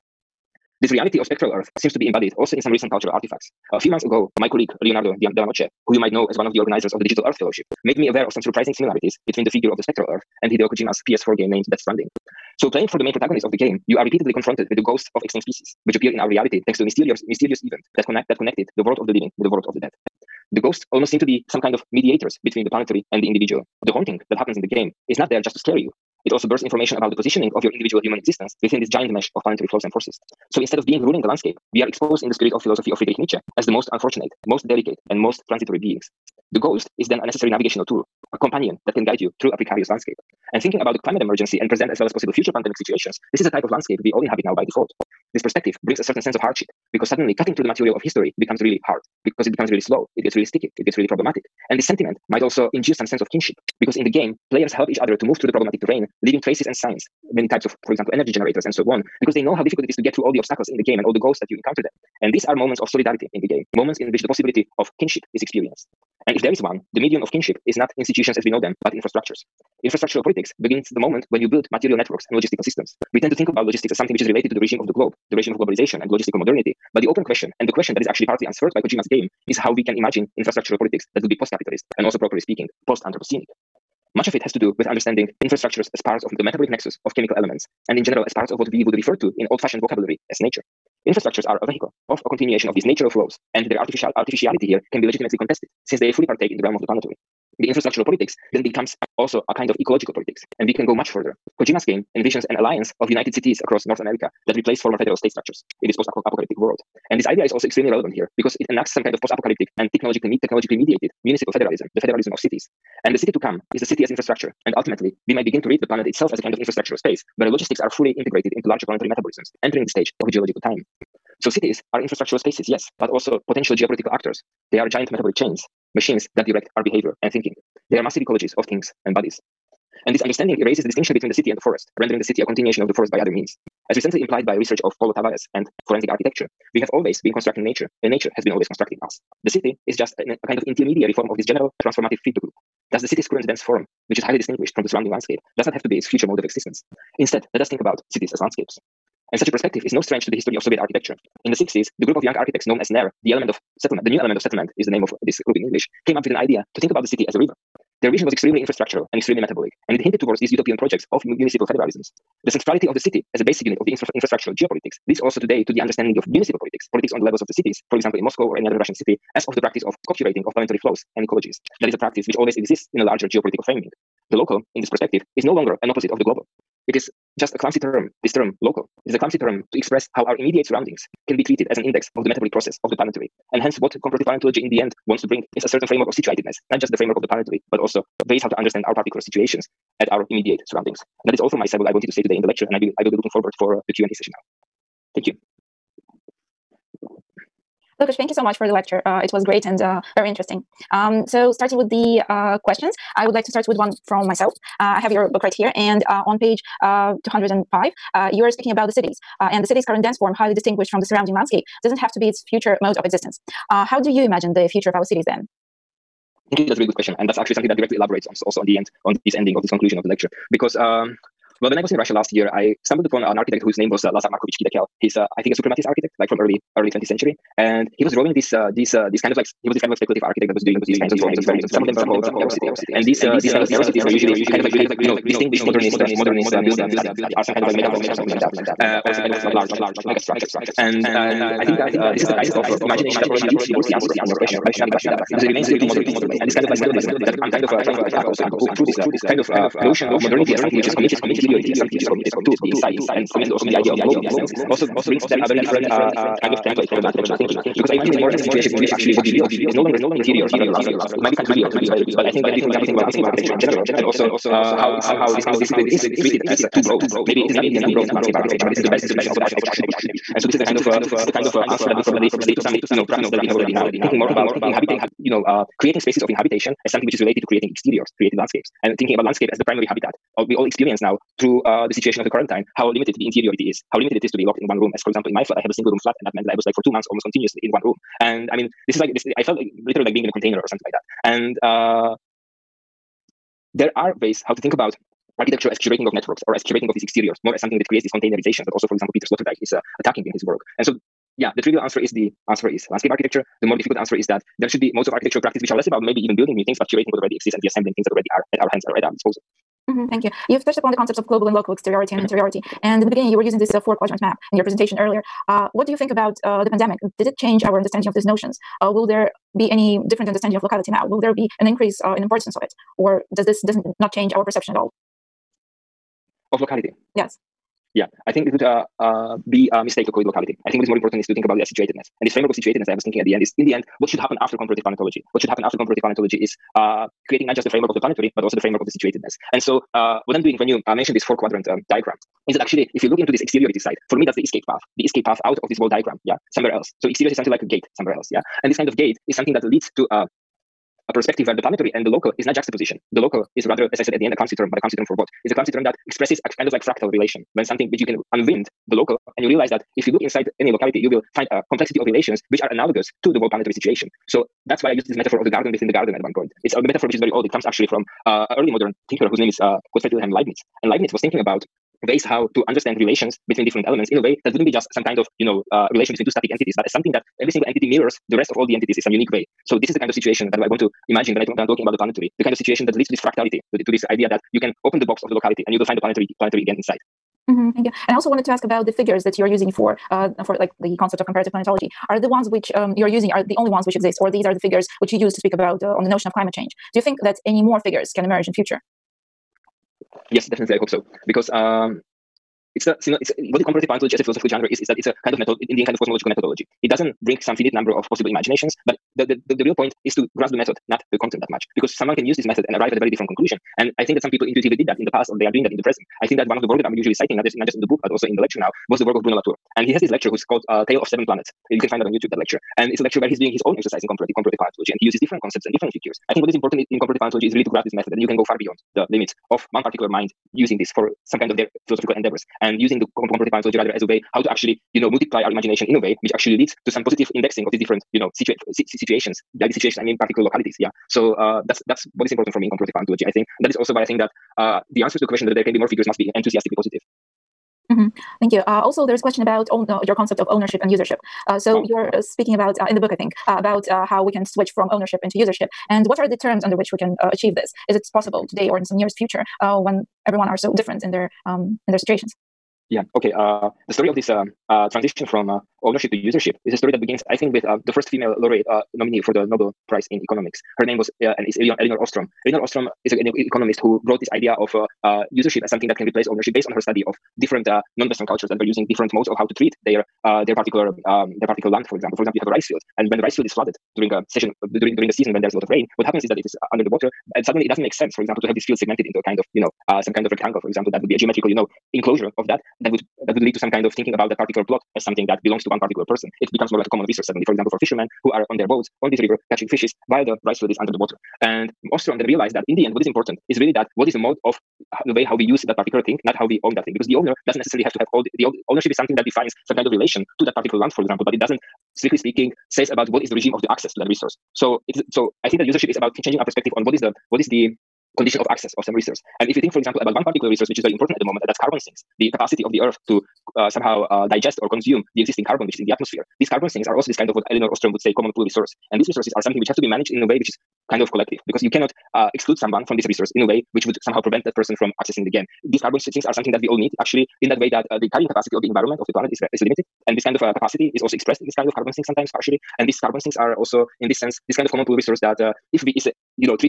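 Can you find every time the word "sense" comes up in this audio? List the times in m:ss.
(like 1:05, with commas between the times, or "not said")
0:46, 0:53, 4:14, 8:07, 9:04.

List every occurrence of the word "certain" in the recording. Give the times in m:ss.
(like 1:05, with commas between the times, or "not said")
0:46, 3:05.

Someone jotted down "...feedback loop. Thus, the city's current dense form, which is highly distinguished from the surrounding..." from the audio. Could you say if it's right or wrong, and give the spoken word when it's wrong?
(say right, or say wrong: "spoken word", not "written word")
right.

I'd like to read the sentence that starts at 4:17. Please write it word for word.
Because I imagine it more as a situation in which actually what we build is no longer interiors, but rather landscapes.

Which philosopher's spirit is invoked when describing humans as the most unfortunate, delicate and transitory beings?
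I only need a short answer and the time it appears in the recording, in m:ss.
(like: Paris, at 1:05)
Friedrich Nietzsche, at 0:32.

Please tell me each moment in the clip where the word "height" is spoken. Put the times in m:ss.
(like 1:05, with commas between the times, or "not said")
not said.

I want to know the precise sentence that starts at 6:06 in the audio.
It's a metaphor which is very old.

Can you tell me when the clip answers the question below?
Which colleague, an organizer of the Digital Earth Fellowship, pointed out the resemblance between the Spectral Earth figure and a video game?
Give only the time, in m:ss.
0:04.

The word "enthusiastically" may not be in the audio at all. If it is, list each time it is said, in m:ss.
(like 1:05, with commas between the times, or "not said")
7:26.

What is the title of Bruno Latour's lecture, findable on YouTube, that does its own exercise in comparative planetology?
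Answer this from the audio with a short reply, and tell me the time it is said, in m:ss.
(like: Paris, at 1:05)
Tale of Seven Planets, at 7:00.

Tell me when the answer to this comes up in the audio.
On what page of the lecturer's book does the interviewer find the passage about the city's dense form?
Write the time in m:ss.
3:27.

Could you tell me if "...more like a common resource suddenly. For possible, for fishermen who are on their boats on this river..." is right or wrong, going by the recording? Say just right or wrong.
wrong.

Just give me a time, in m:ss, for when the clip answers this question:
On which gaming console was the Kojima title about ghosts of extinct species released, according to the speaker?
0:11.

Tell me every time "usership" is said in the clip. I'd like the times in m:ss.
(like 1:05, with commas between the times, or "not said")
7:30, 7:35, 7:46, 7:55, 8:35.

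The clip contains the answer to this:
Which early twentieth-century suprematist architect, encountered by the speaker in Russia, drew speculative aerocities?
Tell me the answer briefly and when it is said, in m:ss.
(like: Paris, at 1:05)
Lazar Markovich Khidekel, at 3:44.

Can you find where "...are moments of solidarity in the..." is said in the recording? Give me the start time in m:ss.
1:02.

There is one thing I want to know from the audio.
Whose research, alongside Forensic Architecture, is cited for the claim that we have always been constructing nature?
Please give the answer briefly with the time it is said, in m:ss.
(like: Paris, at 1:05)
Paulo Tavares, at 2:15.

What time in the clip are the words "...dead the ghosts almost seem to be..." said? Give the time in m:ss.
0:19.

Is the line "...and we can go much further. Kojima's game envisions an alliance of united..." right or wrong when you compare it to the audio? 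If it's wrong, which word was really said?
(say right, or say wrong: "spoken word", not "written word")
right.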